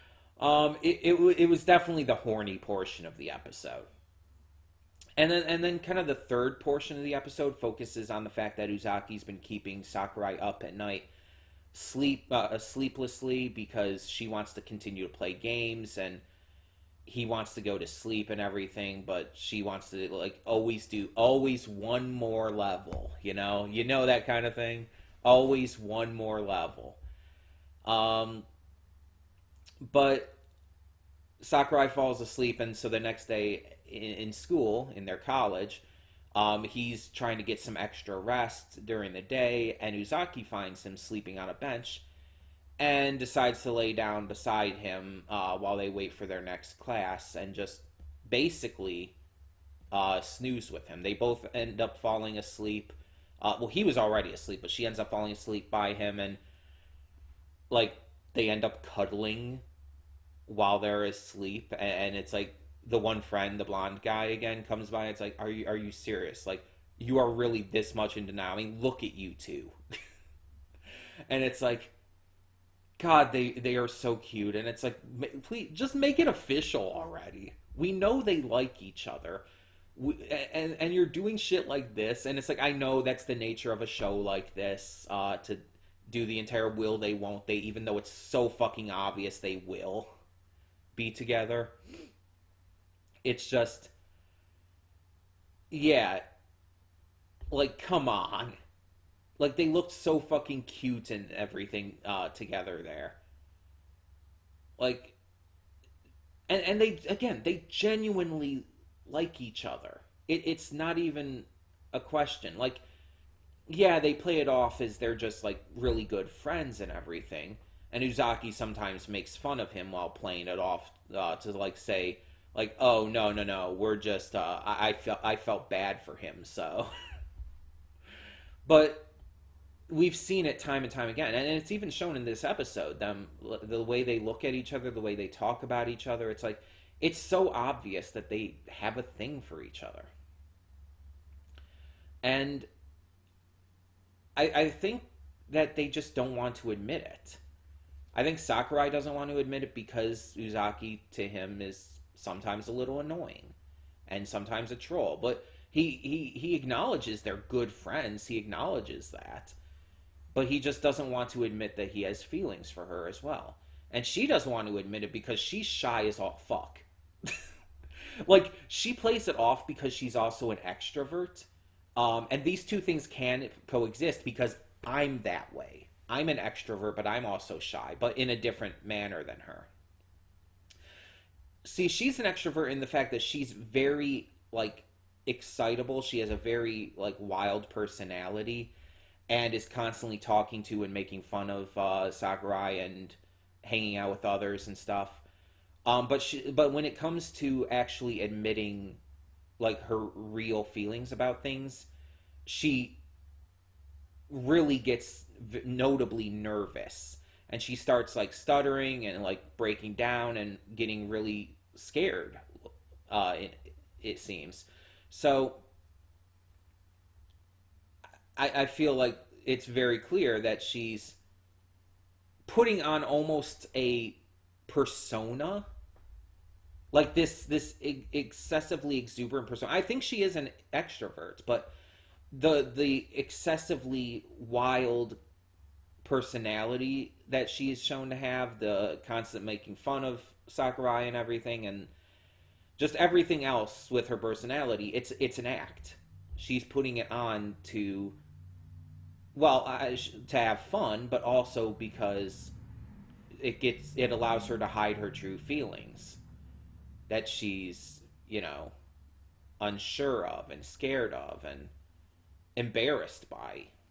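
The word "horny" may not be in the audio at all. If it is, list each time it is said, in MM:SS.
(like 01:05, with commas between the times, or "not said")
00:02.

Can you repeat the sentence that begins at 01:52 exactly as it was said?
Like, yeah, they play it off as they're just like really good friends and everything.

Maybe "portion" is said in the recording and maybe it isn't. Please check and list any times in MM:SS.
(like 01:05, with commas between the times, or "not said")
00:02, 00:06.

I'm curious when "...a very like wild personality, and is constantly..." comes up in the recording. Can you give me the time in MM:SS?
03:06.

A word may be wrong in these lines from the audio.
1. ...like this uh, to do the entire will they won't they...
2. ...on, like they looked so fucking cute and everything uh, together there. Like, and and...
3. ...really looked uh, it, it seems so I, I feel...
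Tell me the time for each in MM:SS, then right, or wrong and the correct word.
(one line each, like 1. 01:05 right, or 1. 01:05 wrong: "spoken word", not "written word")
1. 01:24 right
2. 01:38 right
3. 03:31 wrong: "scared", not "looked".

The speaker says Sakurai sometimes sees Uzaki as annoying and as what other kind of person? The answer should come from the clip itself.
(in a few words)
A troll.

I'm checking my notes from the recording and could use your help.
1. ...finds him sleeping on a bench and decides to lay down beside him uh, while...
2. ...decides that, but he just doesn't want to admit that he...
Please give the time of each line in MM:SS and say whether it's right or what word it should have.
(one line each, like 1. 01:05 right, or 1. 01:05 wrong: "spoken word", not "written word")
1. 00:40 right
2. 02:38 wrong: "acknowledges", not "decides".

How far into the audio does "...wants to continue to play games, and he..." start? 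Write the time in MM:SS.
00:14.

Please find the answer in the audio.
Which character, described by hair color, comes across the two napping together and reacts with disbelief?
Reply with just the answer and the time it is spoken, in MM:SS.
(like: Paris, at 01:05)
The blonde guy, at 01:03.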